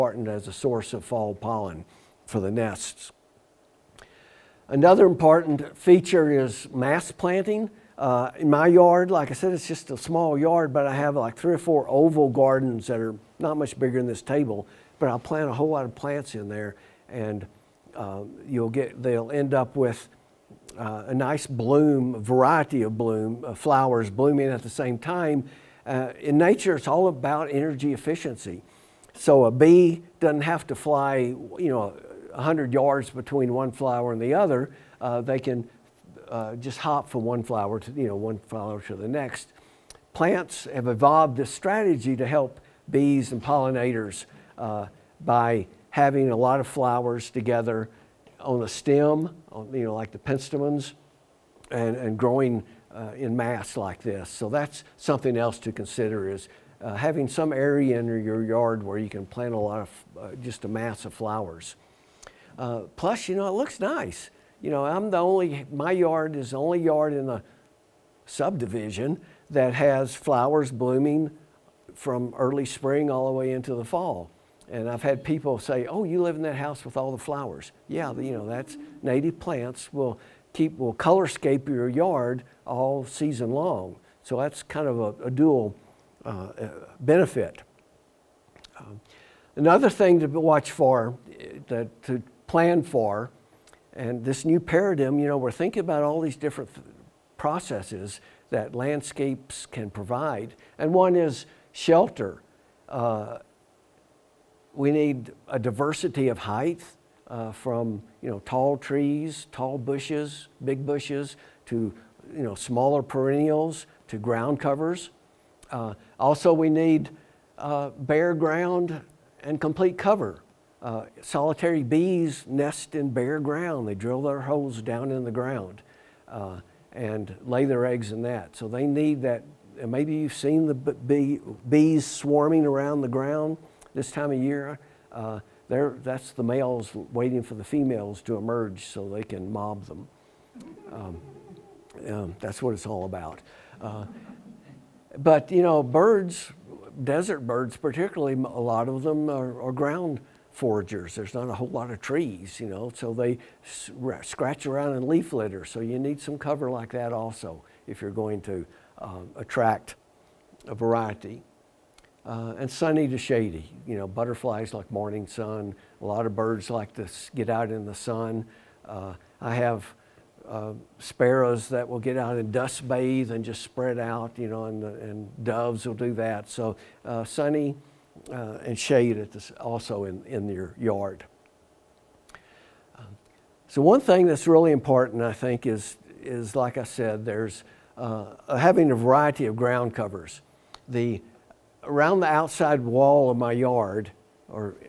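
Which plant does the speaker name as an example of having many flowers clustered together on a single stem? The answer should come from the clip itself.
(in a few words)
penstemons.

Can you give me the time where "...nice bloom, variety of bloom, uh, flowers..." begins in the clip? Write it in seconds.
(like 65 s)
21 s.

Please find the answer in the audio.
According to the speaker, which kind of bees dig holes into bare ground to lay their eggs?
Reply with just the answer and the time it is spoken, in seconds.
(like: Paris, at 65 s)
solitary bees, at 121 s.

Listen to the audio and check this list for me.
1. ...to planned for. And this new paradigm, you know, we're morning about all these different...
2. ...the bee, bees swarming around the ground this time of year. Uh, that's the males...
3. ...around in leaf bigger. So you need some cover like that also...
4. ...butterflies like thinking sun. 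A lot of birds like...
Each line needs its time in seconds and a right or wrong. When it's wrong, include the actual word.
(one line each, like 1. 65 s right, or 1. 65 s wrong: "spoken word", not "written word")
1. 92 s wrong: "thinking", not "morning"
2. 130 s right
3. 154 s wrong: "litter", not "bigger"
4. 164 s wrong: "morning", not "thinking".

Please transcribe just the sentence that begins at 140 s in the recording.
Um, um, that's what it's all about.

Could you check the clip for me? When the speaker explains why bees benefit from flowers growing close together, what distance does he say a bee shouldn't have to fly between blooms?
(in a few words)
100 yards.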